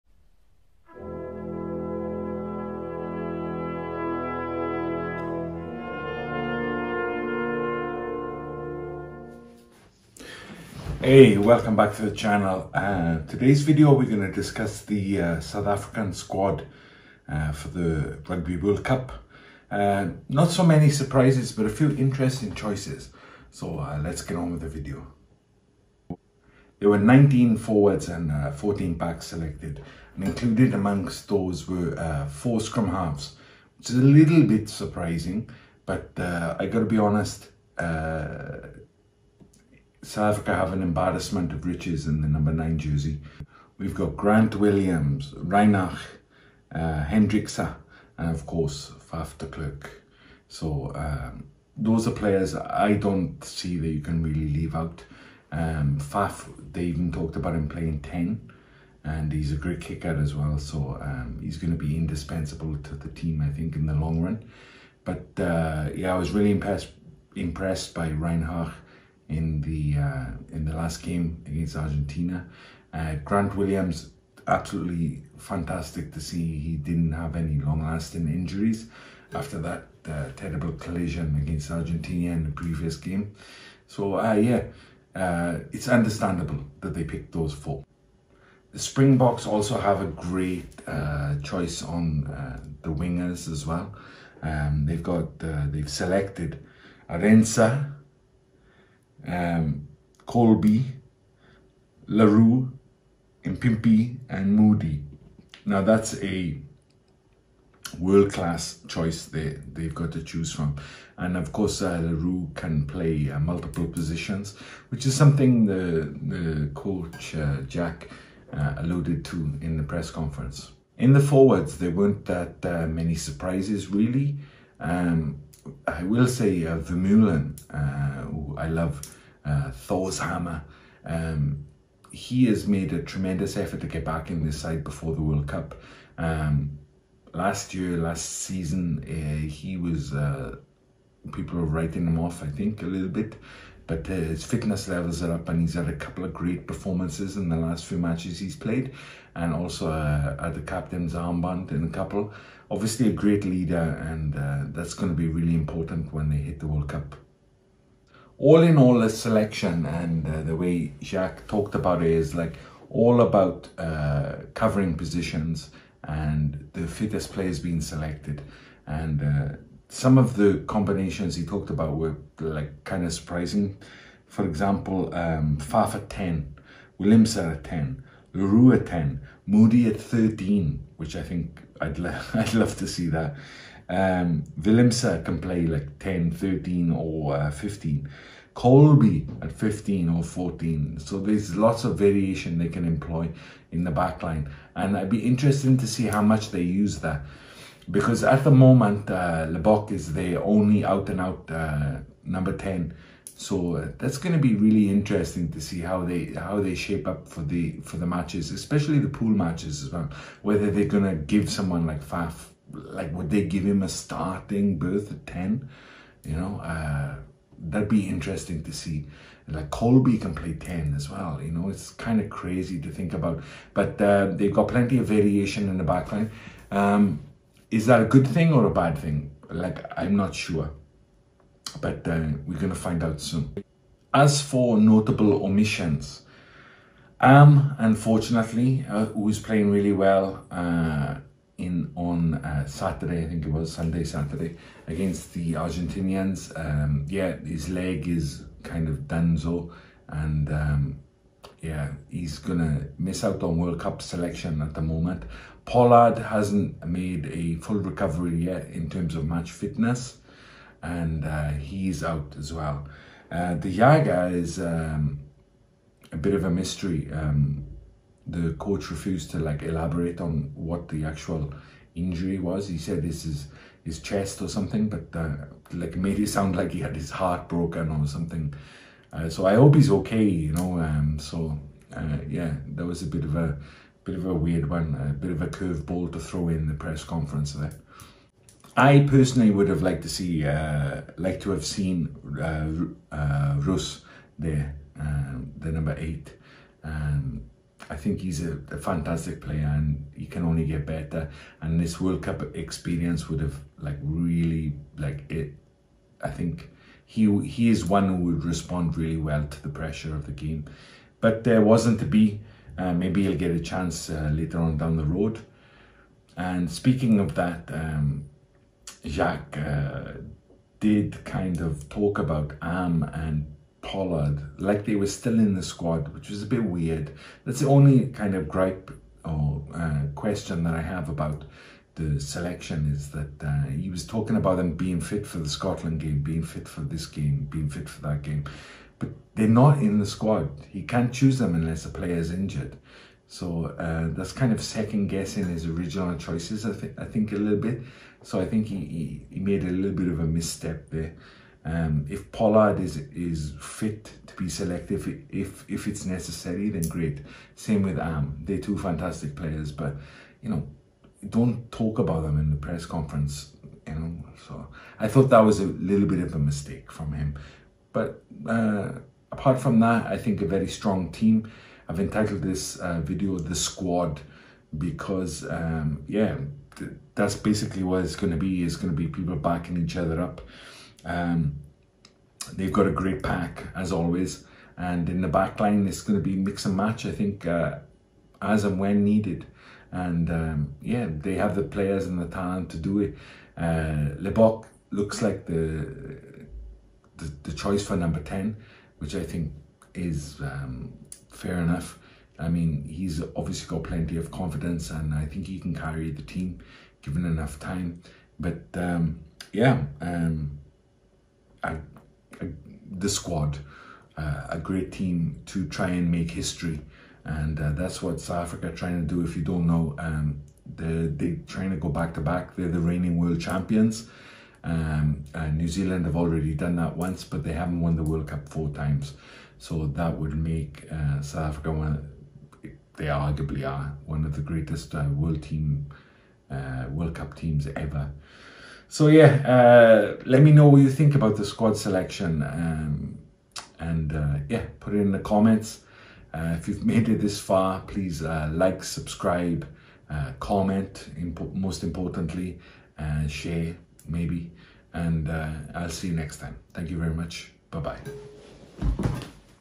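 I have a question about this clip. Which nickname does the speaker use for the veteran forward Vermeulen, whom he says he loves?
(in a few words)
Thor's hammer.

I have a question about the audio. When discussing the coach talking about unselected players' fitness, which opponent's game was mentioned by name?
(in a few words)
Scotland.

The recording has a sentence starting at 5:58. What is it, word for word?
They're two fantastic players, but you know, don't talk about them in the press conference.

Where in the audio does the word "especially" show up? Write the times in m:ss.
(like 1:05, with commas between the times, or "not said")
3:28.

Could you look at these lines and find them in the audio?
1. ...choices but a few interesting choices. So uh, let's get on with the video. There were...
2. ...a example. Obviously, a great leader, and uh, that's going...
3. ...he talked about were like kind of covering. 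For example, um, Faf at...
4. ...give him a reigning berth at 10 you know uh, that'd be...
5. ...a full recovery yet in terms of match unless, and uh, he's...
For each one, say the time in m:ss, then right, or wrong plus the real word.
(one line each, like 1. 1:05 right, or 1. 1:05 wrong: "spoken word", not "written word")
1. 0:20 wrong: "surprises", not "choices"
2. 2:31 wrong: "couple", not "example"
3. 2:51 wrong: "surprising", not "covering"
4. 3:33 wrong: "starting", not "reigning"
5. 4:17 wrong: "fitness", not "unless".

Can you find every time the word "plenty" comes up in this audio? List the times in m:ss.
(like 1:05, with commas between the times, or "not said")
3:44, 6:43.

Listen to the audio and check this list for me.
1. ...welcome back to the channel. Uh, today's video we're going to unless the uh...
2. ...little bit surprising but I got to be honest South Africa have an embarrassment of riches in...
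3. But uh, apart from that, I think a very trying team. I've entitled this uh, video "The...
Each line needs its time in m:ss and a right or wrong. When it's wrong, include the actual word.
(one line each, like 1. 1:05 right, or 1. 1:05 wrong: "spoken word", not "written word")
1. 0:11 wrong: "discuss", not "unless"
2. 0:34 right
3. 6:07 wrong: "strong", not "trying".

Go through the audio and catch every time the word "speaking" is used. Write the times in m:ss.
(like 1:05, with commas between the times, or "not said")
5:16.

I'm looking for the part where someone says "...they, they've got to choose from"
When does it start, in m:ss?
1:49.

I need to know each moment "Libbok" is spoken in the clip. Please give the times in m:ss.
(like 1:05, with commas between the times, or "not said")
3:19, 6:34.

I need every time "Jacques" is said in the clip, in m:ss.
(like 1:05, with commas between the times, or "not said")
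2:41, 5:19.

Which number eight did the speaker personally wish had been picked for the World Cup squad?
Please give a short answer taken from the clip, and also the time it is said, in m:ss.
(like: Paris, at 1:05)
Roos, at 4:53.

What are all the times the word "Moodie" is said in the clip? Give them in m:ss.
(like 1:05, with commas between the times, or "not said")
1:44, 2:59.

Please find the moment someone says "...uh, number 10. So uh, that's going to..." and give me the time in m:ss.
3:21.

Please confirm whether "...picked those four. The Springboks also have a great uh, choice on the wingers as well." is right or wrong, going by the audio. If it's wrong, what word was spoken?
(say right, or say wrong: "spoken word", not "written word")
right.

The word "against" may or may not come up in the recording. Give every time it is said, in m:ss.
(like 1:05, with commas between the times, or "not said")
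1:11, 1:21, 4:04.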